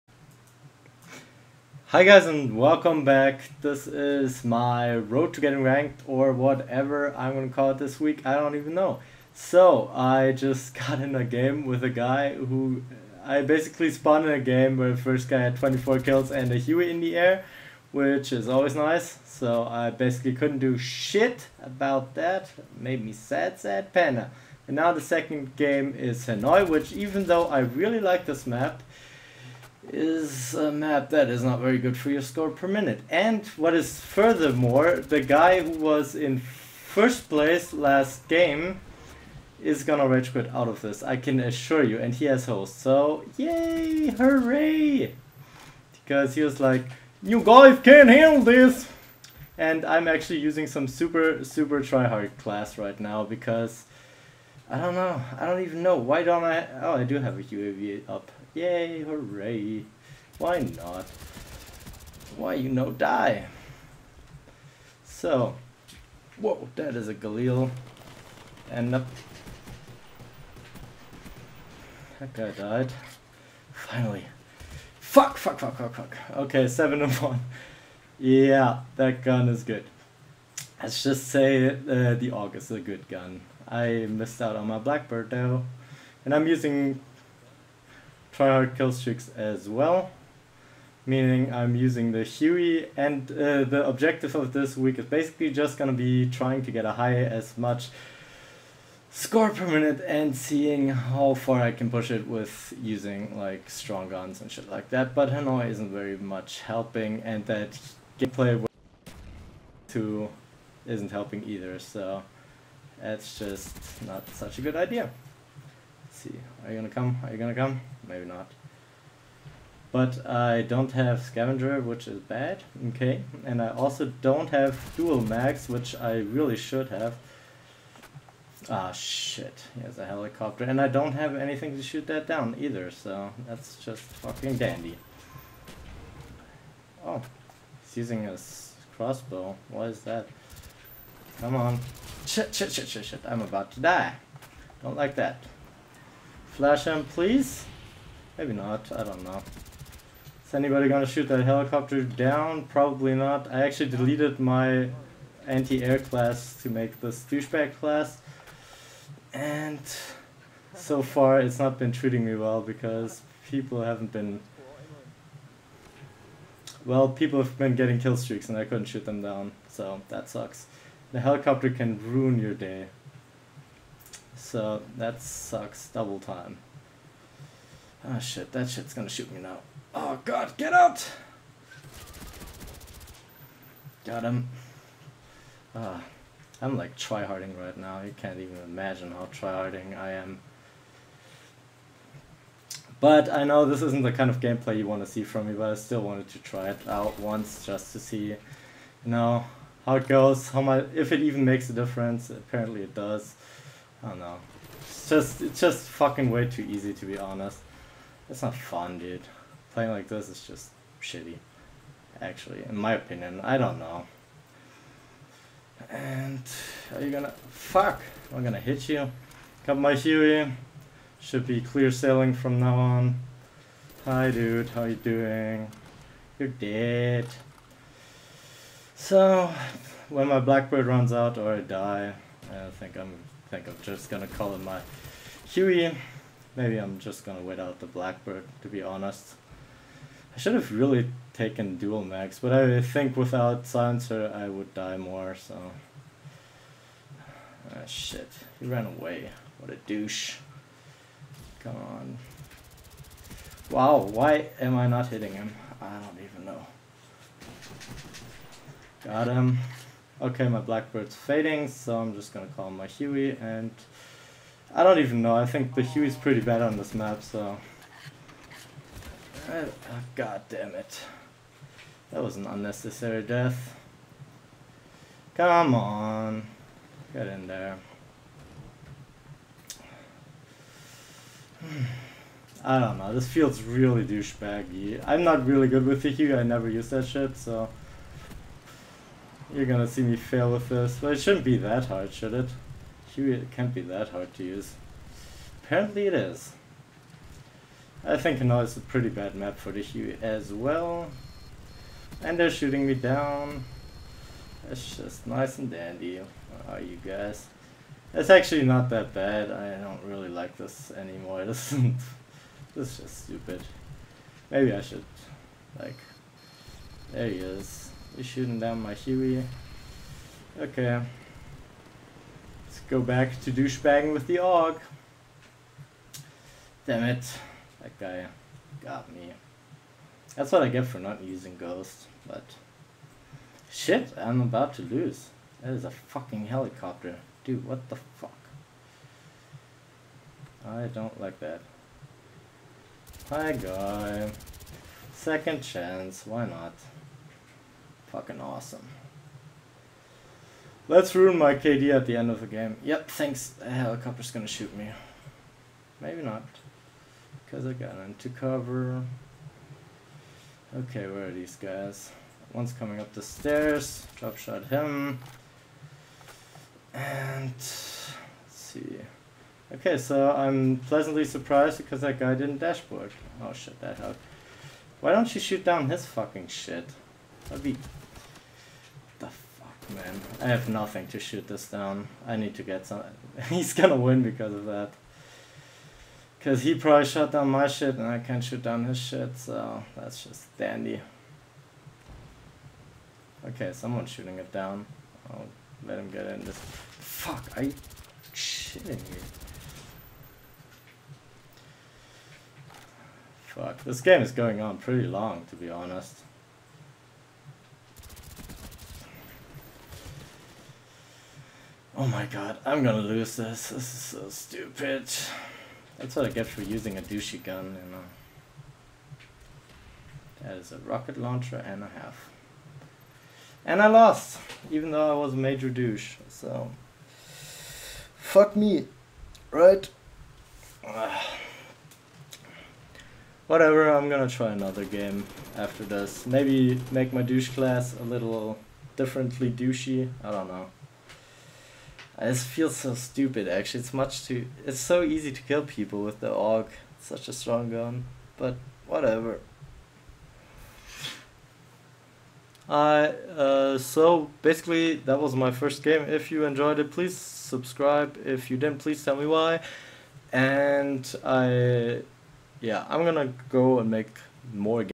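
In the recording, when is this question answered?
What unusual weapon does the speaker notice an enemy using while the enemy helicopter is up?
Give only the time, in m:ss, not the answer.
2:18.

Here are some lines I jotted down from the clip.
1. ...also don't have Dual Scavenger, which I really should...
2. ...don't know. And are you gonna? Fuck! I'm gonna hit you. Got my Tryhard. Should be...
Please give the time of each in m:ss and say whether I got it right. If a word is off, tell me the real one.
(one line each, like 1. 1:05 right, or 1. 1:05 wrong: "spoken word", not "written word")
1. 2:03 wrong: "Mags", not "Scavenger"
2. 3:33 wrong: "Huey", not "Tryhard".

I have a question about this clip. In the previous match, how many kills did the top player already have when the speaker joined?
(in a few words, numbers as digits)
24.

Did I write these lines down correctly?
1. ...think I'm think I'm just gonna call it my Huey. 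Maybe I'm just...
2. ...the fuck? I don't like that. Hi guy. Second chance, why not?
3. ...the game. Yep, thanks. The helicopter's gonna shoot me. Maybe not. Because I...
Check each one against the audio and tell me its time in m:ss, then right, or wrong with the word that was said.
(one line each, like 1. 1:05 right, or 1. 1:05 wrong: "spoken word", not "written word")
1. 3:52 right
2. 5:37 right
3. 5:52 right.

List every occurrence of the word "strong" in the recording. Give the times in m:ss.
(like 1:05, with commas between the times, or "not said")
1:43, 7:27.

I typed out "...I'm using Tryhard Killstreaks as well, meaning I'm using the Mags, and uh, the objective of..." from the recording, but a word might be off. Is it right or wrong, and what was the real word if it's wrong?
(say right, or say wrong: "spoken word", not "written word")
wrong: "Huey", not "Mags".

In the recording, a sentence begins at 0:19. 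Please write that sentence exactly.
So I basically couldn't do shit about that.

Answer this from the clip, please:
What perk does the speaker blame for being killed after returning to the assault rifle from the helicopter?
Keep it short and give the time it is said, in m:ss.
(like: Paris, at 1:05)
Ghost, at 5:31.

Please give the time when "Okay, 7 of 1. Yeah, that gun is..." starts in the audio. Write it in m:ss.
1:16.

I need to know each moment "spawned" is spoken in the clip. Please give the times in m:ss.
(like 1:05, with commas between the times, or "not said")
0:13.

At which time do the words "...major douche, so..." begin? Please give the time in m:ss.
7:05.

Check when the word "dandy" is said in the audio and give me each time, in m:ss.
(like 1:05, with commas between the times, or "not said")
2:14, 5:05, 6:30.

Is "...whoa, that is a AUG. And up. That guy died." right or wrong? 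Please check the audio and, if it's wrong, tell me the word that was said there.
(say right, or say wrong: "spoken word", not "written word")
wrong: "Galil", not "AUG".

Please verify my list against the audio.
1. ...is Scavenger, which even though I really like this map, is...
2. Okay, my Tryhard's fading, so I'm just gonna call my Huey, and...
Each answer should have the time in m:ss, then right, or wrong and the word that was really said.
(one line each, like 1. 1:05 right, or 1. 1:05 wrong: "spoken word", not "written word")
1. 0:25 wrong: "Hanoi", not "Scavenger"
2. 4:20 wrong: "Blackbird", not "Tryhard".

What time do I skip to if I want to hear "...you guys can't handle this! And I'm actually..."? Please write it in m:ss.
0:47.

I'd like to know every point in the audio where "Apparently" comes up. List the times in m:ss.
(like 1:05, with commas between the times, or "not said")
3:22, 4:55.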